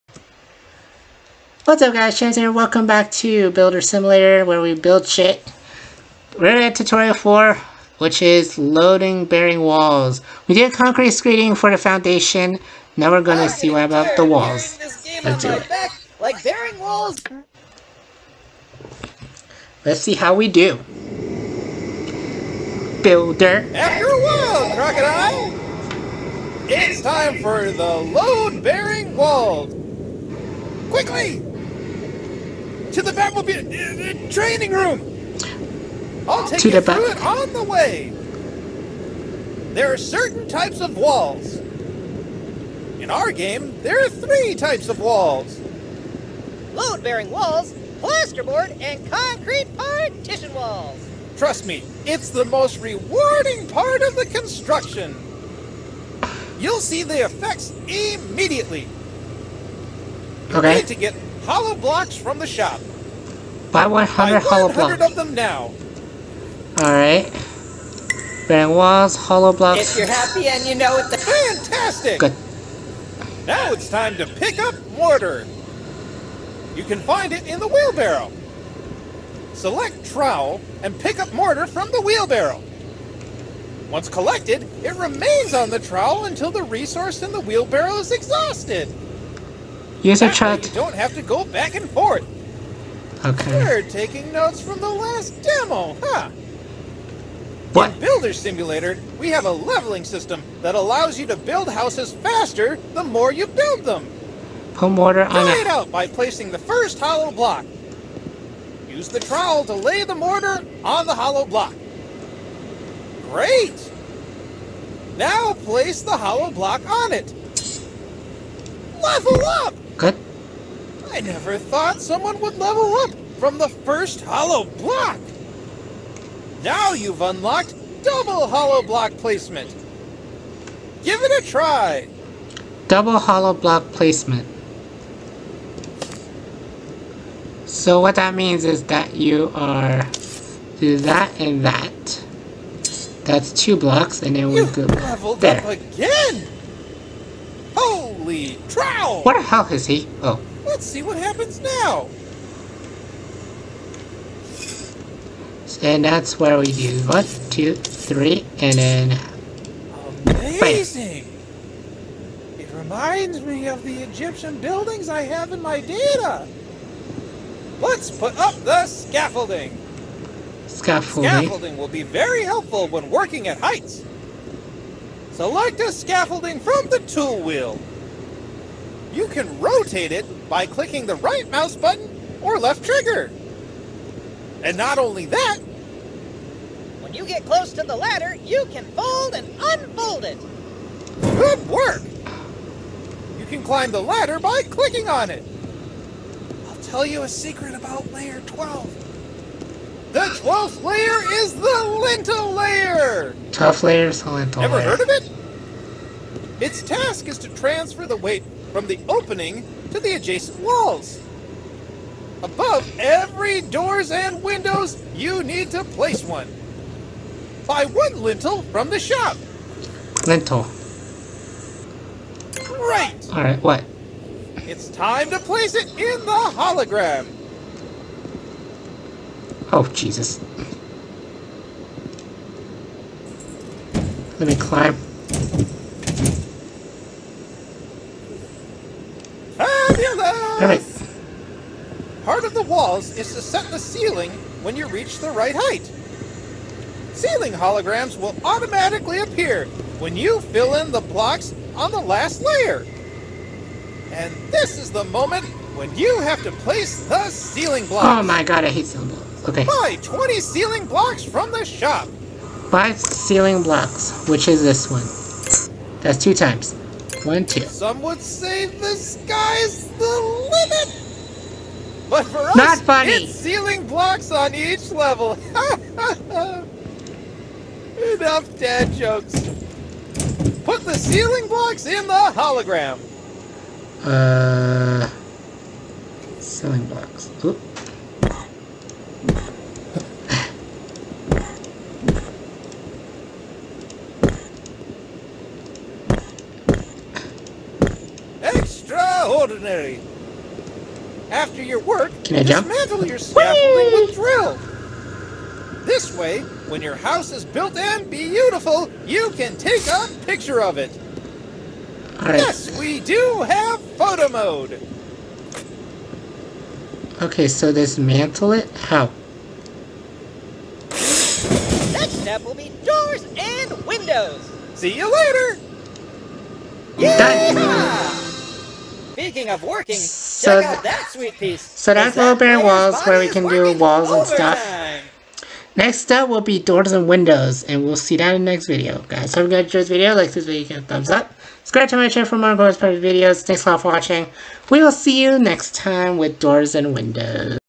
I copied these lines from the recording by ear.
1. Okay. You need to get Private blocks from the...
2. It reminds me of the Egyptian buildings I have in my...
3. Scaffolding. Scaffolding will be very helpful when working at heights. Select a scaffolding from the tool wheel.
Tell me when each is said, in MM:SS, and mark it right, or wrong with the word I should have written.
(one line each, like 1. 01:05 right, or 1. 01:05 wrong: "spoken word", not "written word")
1. 01:00 wrong: "Hollow", not "Private"
2. 02:42 right
3. 02:50 right.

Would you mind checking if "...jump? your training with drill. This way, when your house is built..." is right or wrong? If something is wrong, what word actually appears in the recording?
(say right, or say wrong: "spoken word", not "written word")
wrong: "scaffolding", not "training".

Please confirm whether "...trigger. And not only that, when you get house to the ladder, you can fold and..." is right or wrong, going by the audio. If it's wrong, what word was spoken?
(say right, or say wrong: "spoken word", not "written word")
wrong: "close", not "house".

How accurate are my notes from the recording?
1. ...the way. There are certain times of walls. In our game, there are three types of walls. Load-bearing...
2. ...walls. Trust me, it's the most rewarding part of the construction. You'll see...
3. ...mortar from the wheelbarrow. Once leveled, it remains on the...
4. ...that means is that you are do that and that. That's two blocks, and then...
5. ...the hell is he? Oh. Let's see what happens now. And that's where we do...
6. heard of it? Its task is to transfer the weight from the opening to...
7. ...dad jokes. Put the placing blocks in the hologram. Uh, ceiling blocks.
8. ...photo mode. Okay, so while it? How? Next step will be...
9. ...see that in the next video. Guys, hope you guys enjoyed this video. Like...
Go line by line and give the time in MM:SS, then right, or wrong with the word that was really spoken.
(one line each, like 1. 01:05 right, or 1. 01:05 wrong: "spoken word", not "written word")
1. 00:37 wrong: "types", not "times"
2. 00:50 right
3. 01:21 wrong: "collected", not "leveled"
4. 02:18 right
5. 02:29 right
6. 03:24 right
7. 04:38 wrong: "ceiling", not "placing"
8. 05:13 wrong: "dismantle", not "while"
9. 05:37 right.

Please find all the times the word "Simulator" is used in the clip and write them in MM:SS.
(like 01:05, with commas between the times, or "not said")
00:03, 01:38.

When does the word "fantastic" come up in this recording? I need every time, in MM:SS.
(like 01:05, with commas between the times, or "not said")
01:11.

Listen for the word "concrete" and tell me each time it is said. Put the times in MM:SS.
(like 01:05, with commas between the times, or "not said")
00:10, 00:49.